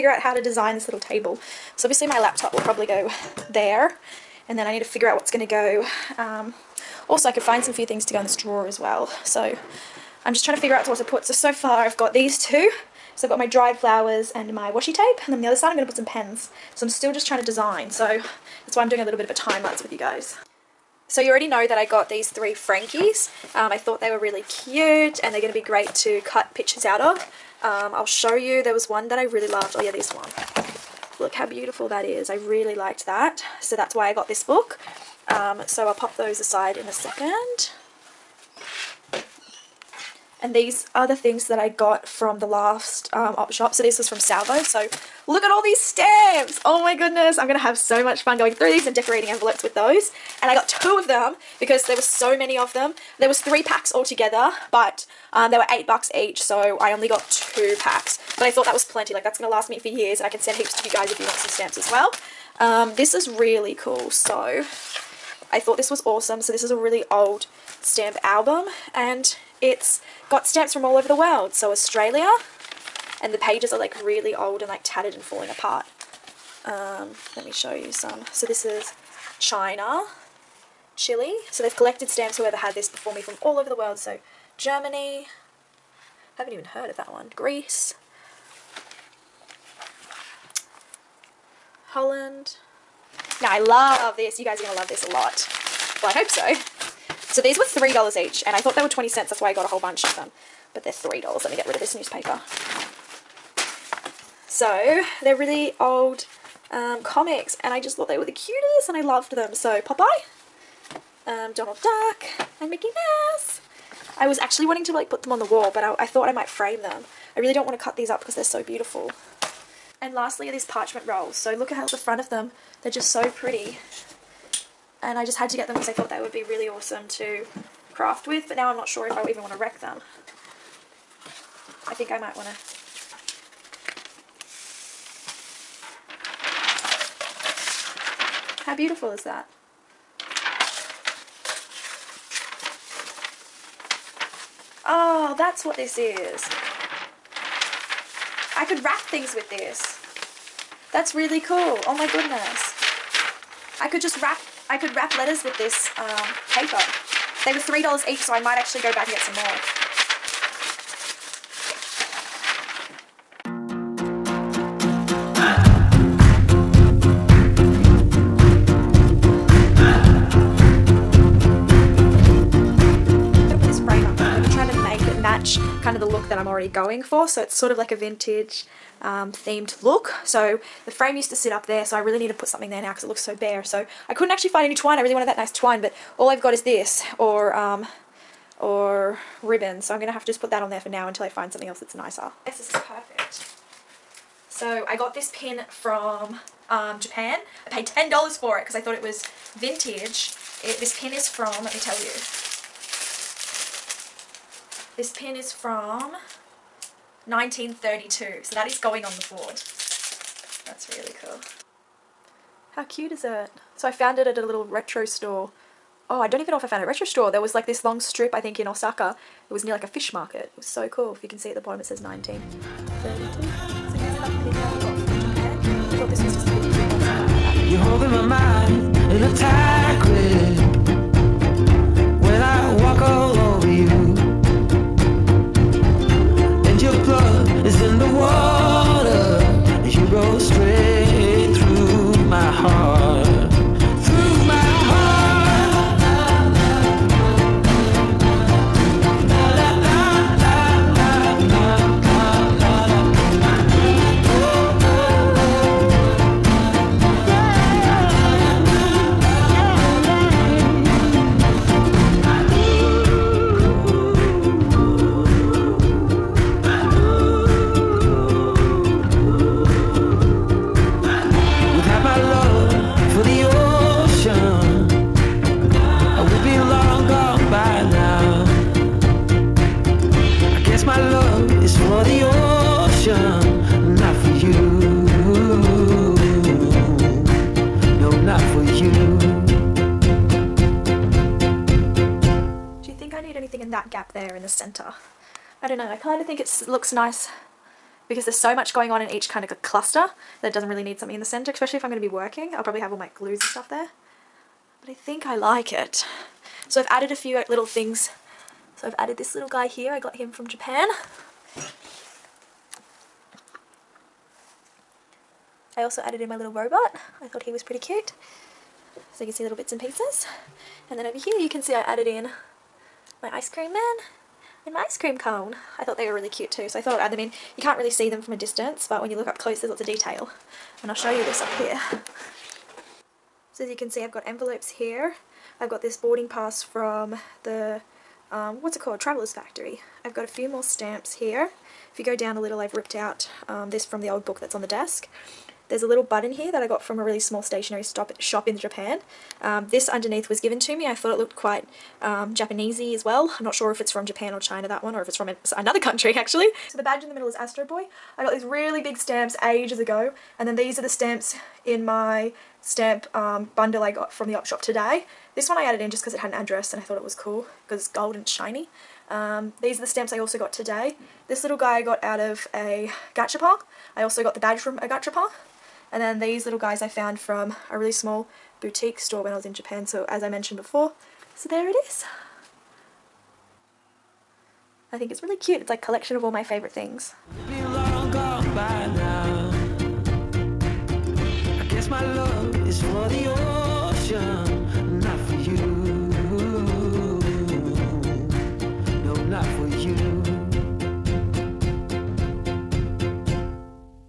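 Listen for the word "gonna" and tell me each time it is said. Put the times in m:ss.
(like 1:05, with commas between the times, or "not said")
0:47, 0:59, 3:10.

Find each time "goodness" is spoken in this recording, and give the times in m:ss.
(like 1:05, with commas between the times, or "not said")
0:46, 2:32.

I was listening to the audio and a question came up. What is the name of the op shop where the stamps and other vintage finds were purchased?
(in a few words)
Salvo.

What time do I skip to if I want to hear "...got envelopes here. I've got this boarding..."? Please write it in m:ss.
5:34.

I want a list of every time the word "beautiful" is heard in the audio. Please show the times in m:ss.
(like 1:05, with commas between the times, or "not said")
0:31, 1:58, 2:18.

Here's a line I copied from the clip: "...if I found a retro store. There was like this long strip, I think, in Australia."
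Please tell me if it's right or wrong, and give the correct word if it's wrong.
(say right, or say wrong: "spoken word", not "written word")
wrong: "Osaka", not "Australia".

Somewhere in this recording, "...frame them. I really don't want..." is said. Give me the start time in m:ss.
1:56.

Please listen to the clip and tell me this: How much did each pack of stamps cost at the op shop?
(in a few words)
$8.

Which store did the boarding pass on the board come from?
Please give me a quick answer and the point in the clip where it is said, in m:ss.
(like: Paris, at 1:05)
Traveler's Factory, at 5:38.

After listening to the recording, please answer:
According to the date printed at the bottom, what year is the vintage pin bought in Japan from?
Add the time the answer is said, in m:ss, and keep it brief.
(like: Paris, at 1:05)
1932, at 3:27.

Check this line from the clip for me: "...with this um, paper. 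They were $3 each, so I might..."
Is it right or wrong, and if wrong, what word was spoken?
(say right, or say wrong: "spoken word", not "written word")
right.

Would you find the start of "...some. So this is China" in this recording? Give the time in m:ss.
1:17.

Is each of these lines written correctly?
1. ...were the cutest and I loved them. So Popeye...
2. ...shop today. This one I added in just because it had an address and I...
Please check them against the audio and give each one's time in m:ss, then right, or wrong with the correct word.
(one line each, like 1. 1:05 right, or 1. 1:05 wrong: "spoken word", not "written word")
1. 1:48 right
2. 6:04 right.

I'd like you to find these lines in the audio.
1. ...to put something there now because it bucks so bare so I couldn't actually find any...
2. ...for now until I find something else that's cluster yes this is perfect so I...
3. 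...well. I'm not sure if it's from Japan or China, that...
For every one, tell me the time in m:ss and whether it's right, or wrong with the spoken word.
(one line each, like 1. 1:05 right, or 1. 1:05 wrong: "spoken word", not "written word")
1. 3:02 wrong: "looks", not "bucks"
2. 3:10 wrong: "nicer", not "cluster"
3. 5:53 right.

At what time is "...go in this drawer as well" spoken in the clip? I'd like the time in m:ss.
0:08.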